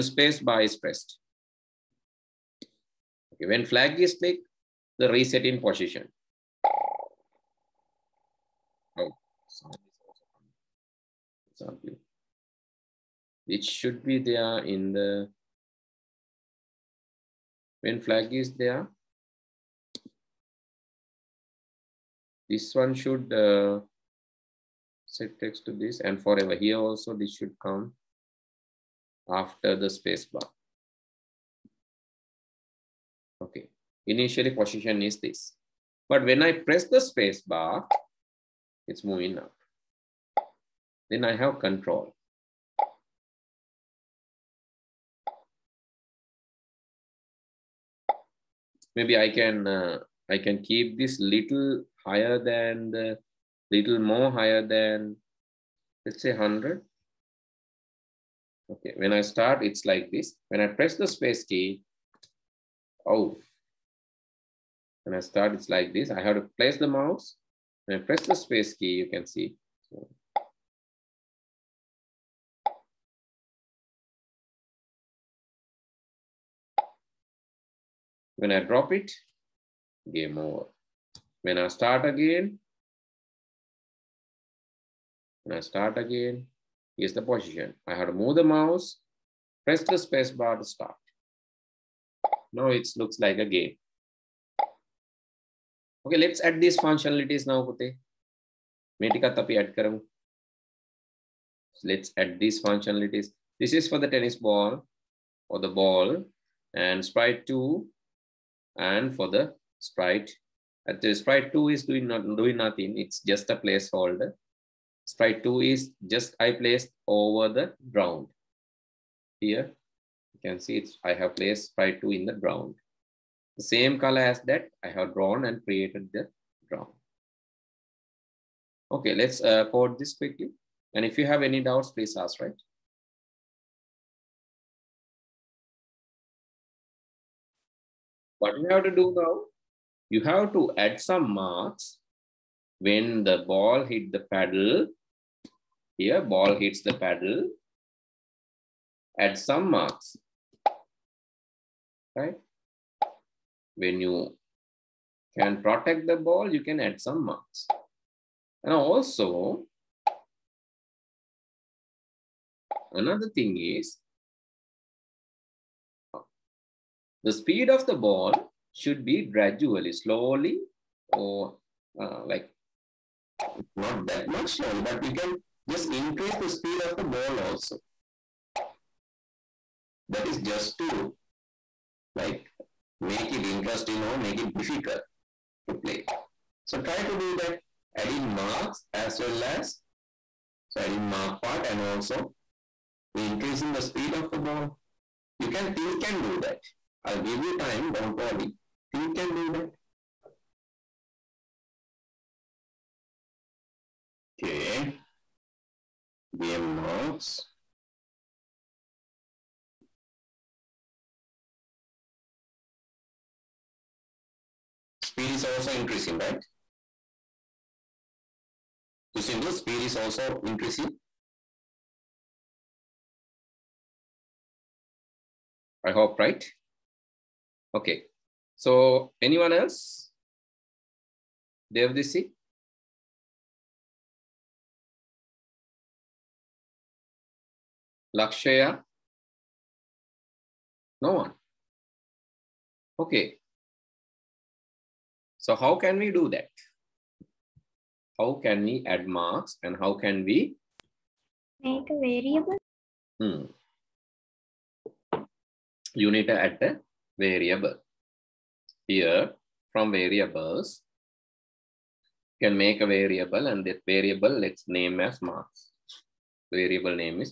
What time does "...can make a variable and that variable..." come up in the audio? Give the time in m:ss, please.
4:22.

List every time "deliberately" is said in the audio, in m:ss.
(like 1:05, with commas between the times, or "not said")
not said.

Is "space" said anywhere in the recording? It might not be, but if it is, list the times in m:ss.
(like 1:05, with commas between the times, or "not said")
0:00, 0:29, 0:36, 1:01, 1:08, 1:29.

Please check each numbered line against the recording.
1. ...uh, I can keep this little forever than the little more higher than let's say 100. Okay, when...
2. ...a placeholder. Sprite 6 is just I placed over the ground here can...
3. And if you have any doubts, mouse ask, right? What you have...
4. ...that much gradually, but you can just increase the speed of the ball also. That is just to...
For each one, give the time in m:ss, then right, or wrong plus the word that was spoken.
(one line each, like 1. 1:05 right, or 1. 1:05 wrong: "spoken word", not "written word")
1. 0:49 wrong: "higher", not "forever"
2. 1:53 wrong: "2", not "6"
3. 2:10 wrong: "please", not "mouse"
4. 2:54 wrong: "slowly", not "gradually".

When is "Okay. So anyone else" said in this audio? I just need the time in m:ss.
3:47.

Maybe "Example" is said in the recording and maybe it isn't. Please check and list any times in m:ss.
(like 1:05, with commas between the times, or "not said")
0:11.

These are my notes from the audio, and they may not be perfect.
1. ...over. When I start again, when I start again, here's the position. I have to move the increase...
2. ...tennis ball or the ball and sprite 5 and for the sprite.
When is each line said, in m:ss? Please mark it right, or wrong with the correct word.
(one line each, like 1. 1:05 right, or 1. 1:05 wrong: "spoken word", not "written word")
1. 1:20 wrong: "mouse", not "increase"
2. 1:44 wrong: "2", not "5".